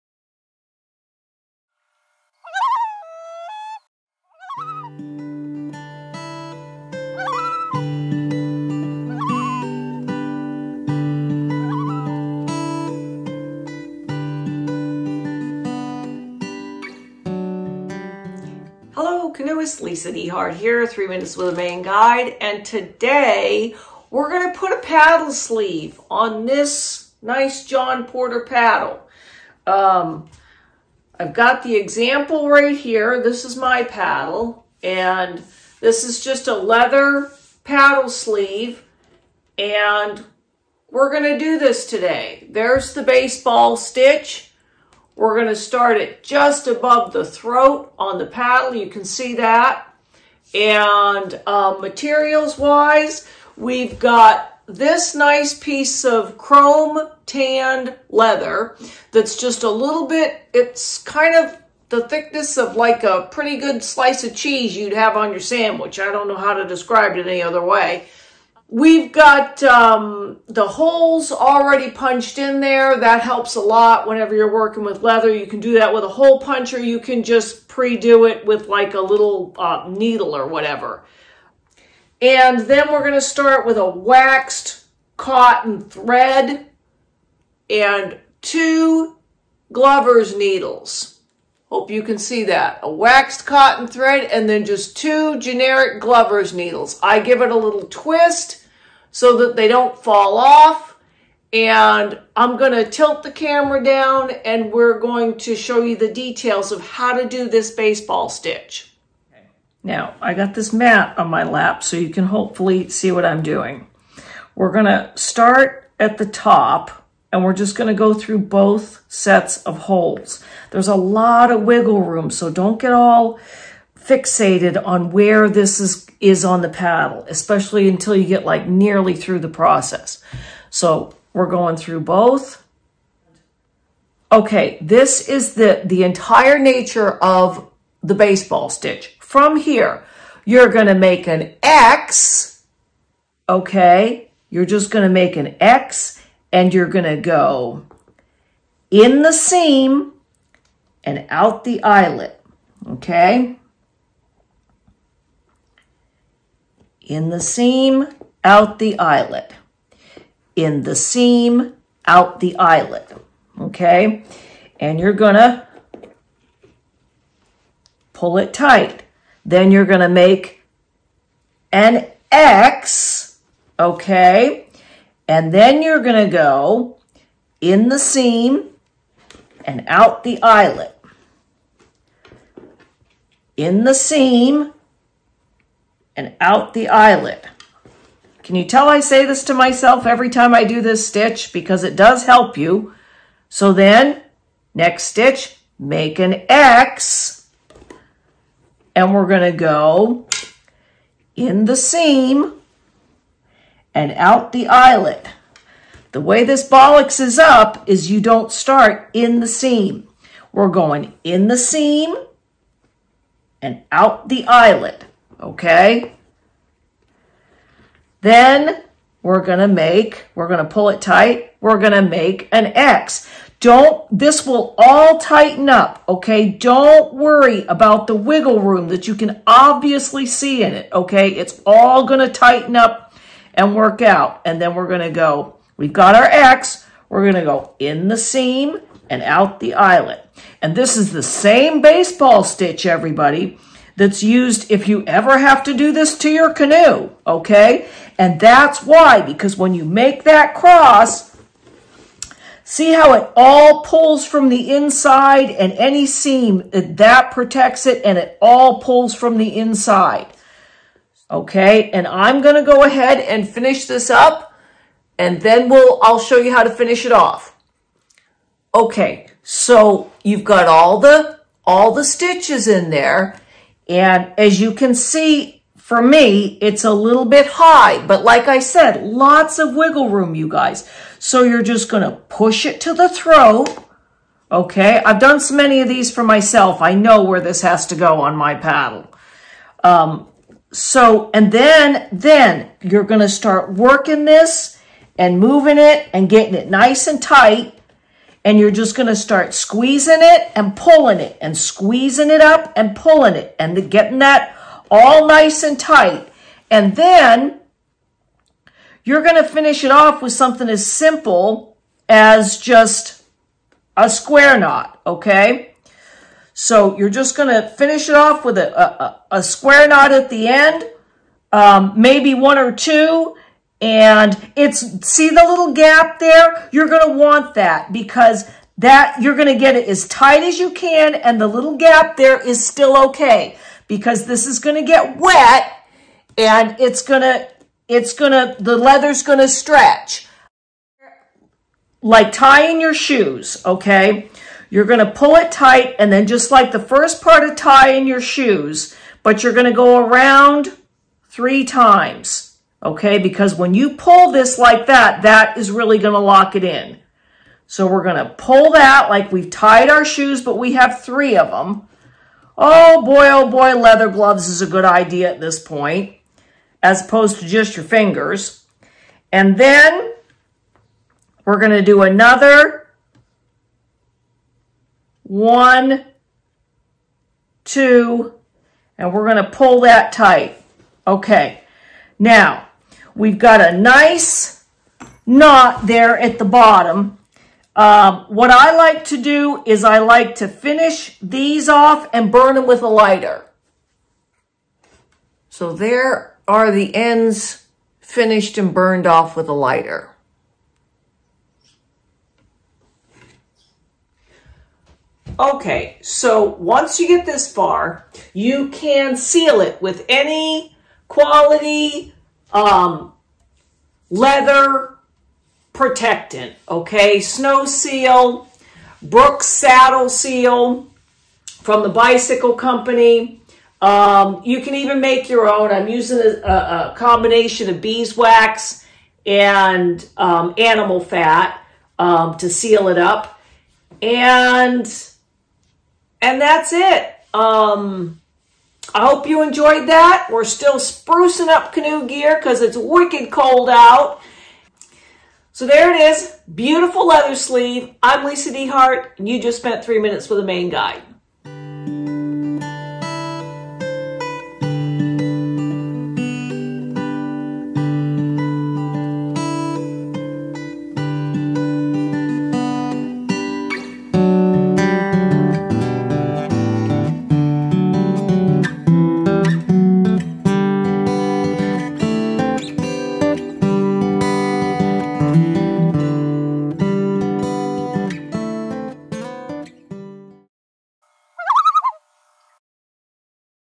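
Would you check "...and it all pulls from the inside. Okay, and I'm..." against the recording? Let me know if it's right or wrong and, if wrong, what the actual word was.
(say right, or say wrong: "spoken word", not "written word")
right.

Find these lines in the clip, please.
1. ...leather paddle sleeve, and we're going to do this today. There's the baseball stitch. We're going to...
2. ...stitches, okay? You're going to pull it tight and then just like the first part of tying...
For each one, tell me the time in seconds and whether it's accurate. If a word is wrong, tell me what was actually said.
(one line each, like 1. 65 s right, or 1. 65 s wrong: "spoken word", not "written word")
1. 36 s right
2. 342 s wrong: "shoes", not "stitches".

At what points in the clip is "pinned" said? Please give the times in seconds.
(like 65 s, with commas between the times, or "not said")
not said.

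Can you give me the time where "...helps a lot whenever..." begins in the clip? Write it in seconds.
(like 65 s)
73 s.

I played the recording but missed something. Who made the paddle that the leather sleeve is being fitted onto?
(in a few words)
John Porter.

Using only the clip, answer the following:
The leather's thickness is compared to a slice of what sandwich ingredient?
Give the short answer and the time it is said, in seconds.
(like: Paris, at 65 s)
Cheese, at 64 s.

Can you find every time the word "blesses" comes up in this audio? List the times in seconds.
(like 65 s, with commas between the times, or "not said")
not said.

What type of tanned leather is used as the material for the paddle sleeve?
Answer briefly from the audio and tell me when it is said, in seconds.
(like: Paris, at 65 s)
Chrome tanned, at 56 s.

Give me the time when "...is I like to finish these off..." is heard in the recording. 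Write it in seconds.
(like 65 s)
389 s.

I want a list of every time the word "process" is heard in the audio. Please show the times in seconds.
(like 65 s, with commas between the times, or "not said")
129 s.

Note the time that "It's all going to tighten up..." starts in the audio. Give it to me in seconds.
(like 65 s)
231 s.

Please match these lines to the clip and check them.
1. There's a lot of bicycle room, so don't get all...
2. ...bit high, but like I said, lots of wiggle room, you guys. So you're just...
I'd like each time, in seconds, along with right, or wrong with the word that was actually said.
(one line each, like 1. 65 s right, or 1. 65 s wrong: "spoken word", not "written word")
1. 120 s wrong: "wiggle", not "bicycle"
2. 277 s right.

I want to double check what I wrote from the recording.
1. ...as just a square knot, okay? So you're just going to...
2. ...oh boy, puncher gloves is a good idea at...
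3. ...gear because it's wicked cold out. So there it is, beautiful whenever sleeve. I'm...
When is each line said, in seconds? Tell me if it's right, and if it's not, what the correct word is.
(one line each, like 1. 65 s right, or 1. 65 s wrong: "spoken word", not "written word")
1. 312 s right
2. 363 s wrong: "leather", not "puncher"
3. 442 s wrong: "leather", not "whenever".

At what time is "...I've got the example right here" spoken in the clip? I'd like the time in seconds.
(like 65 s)
31 s.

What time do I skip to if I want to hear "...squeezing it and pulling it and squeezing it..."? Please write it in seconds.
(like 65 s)
299 s.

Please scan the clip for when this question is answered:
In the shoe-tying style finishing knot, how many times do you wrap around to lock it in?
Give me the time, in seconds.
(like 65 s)
351 s.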